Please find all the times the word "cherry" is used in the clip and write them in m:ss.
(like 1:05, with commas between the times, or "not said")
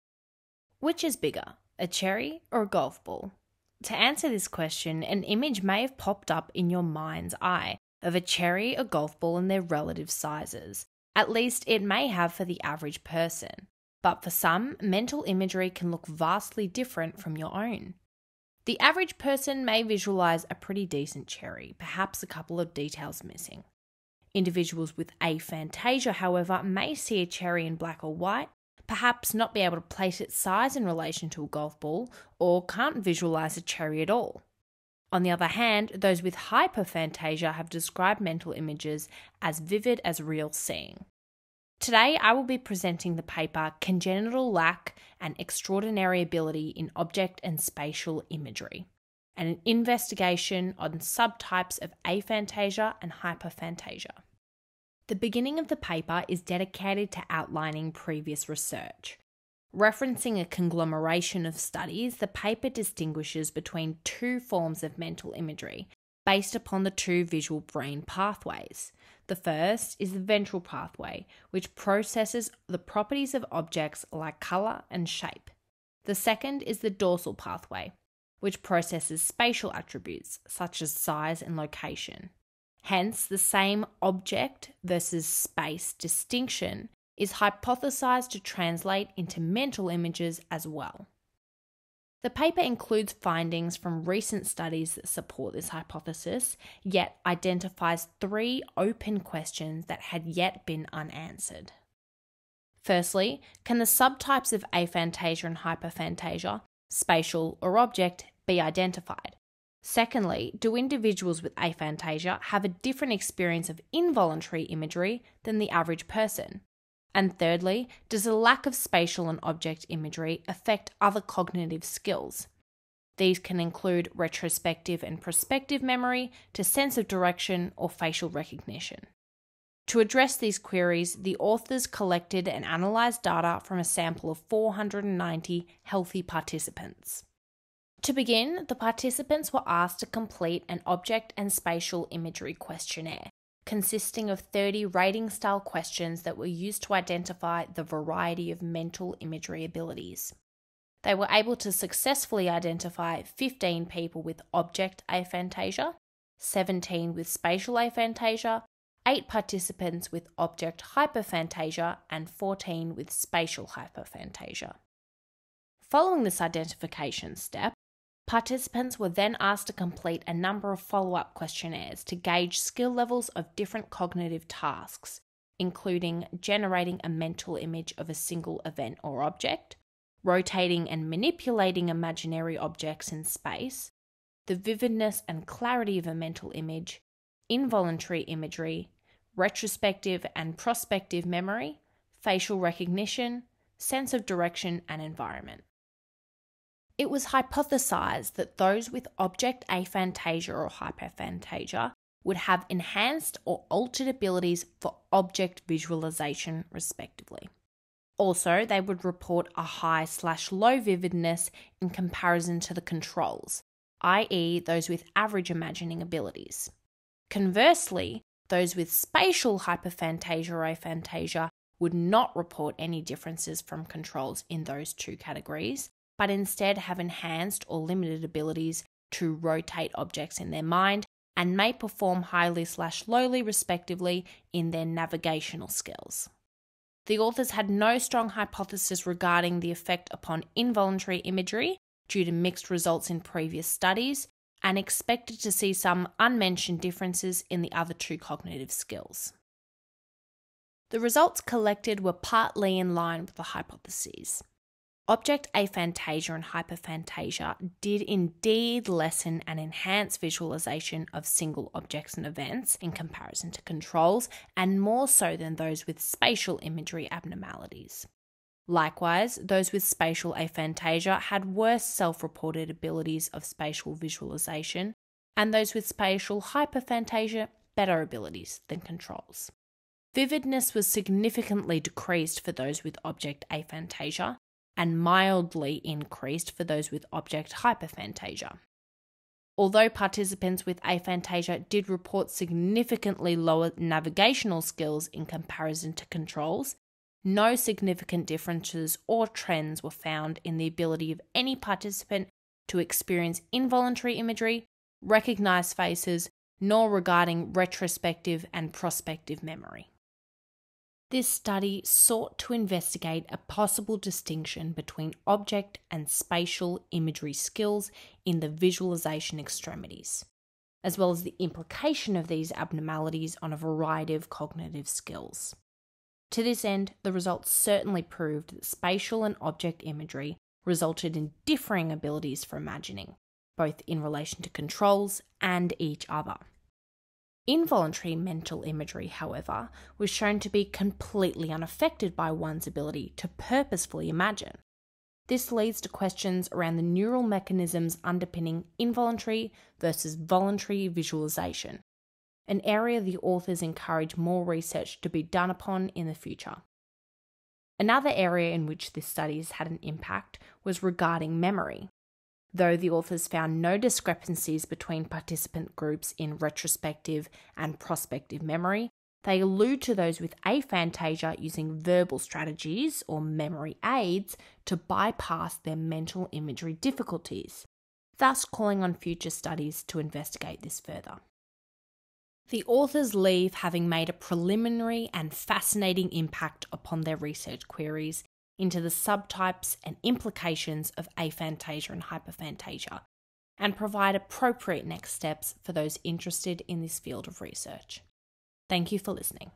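0:01, 0:08, 0:21, 0:27, 0:33.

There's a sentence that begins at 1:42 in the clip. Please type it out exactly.
Firstly, can the subtypes of aphantasia and hyperphantasia, spatial or object, be identified?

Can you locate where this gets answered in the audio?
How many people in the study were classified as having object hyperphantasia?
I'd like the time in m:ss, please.
2:39.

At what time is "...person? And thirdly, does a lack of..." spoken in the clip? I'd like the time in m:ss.
1:56.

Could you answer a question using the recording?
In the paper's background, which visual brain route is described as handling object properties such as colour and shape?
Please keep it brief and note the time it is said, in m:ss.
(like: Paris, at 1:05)
ventral pathway, at 1:10.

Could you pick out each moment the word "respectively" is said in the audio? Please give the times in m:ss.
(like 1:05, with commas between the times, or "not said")
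3:26, 3:53.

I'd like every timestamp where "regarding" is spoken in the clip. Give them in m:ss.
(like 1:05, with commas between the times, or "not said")
3:59, 5:06, 6:00.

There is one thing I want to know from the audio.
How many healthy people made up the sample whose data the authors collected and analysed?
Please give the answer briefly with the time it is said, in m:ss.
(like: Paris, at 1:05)
490, at 2:14.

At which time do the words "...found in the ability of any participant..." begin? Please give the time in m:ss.
4:59.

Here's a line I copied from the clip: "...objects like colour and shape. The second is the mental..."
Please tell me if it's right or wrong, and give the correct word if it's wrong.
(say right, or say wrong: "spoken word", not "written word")
wrong: "dorsal", not "mental".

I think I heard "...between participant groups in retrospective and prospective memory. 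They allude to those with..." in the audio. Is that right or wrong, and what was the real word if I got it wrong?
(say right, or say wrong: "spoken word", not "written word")
right.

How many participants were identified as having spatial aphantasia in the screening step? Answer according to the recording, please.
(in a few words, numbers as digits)
17.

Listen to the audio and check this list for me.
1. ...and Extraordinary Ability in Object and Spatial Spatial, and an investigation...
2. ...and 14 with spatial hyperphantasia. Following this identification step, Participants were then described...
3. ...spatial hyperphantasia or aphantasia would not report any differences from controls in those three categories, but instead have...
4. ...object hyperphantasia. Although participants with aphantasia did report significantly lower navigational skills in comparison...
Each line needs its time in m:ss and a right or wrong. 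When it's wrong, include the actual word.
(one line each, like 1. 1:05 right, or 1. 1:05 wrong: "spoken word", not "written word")
1. 0:45 wrong: "Imagery", not "Spatial"
2. 2:42 wrong: "asked", not "described"
3. 3:38 wrong: "two", not "three"
4. 4:47 right.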